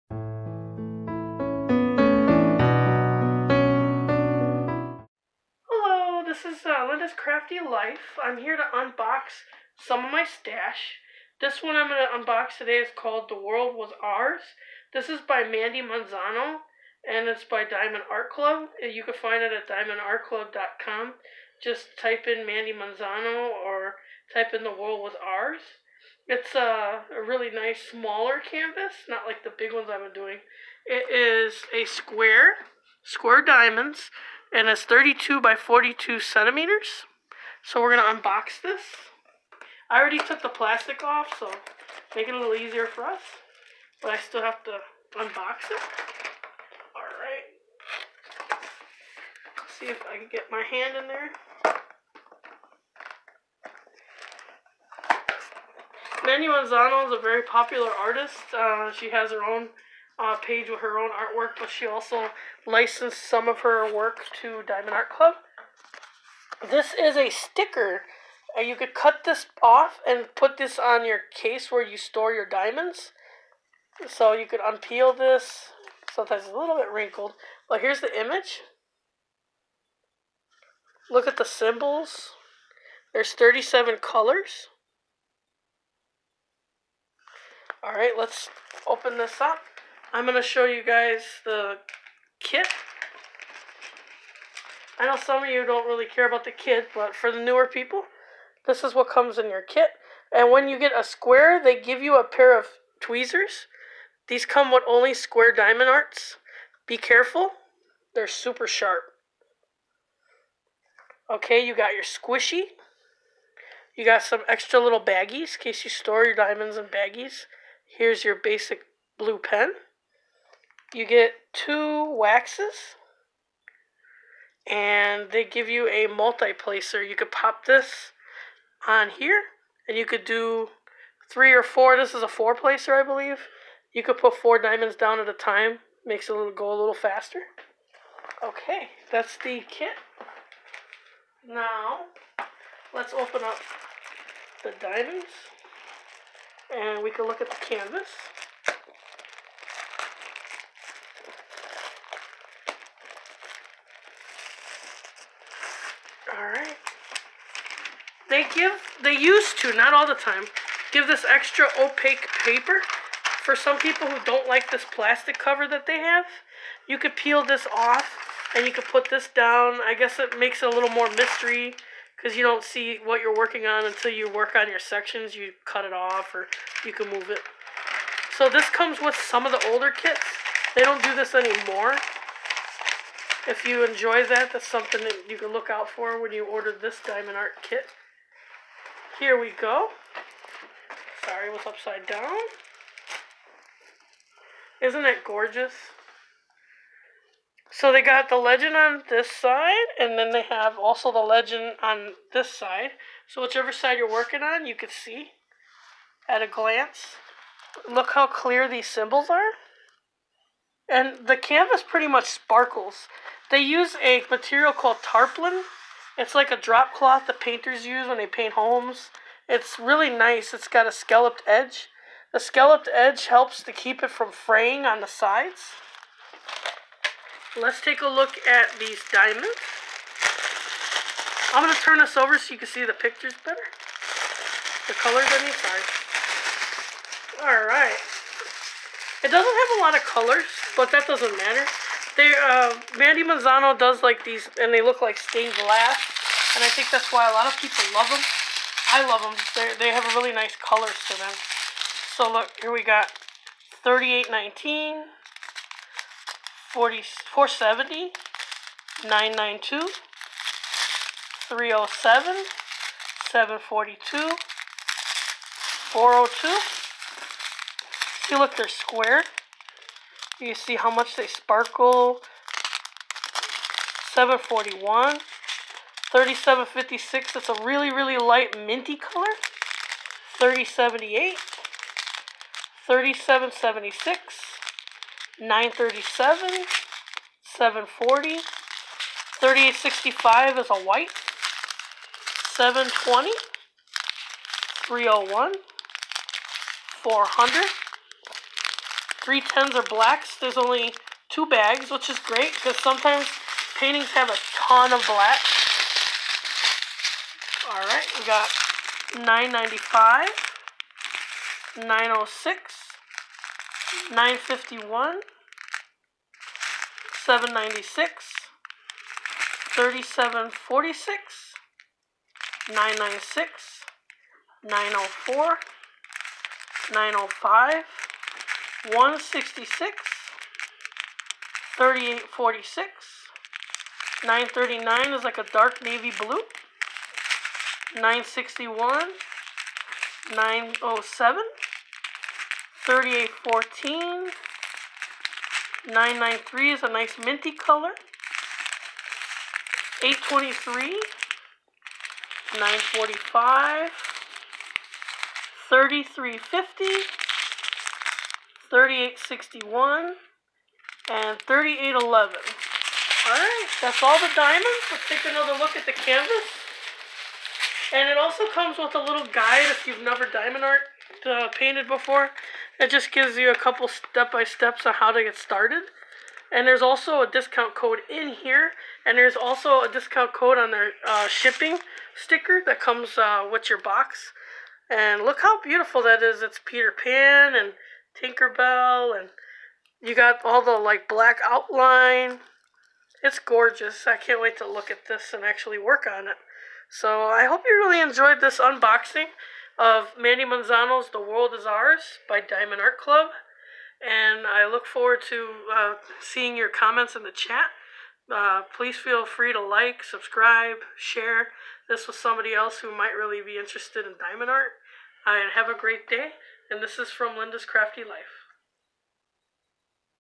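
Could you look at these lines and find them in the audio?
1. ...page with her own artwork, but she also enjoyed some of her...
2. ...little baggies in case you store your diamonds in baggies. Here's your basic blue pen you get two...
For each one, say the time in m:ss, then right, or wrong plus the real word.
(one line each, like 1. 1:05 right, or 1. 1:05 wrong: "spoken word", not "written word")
1. 1:00 wrong: "licensed", not "enjoyed"
2. 1:54 right.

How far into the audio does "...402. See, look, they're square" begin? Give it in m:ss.
4:25.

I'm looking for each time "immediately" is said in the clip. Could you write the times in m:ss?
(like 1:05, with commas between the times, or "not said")
not said.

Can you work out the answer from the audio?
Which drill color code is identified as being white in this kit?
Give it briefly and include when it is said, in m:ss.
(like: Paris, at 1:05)
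3865, at 4:48.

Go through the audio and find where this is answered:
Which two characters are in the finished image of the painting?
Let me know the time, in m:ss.
6:26.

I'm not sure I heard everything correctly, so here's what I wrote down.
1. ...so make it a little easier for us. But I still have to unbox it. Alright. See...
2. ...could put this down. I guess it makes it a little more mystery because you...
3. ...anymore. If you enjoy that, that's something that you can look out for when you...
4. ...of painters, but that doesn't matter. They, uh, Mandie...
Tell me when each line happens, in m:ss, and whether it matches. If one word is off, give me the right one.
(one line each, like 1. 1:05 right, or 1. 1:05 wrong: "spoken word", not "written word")
1. 0:41 right
2. 2:48 right
3. 3:01 right
4. 3:59 wrong: "colors", not "painters".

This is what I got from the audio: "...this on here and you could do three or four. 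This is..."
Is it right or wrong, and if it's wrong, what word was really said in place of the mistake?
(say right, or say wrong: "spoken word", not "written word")
right.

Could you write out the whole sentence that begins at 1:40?
And when you get a square, they give you a pair of tweezers.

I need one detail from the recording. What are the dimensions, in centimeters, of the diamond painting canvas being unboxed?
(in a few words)
32 by 42 centimeters.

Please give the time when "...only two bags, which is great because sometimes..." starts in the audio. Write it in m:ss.
5:00.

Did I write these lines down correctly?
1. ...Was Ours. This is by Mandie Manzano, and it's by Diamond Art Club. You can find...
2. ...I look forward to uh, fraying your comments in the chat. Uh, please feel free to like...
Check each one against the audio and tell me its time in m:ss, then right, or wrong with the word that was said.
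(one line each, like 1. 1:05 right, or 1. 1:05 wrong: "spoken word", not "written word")
1. 0:13 right
2. 6:44 wrong: "seeing", not "fraying".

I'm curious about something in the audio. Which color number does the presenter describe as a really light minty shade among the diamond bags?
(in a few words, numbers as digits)
3756.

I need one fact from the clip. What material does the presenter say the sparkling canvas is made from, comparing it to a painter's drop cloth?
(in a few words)
Tarpaulin.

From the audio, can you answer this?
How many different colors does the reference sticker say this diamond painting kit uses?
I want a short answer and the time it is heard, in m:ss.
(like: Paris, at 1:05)
37, at 1:23.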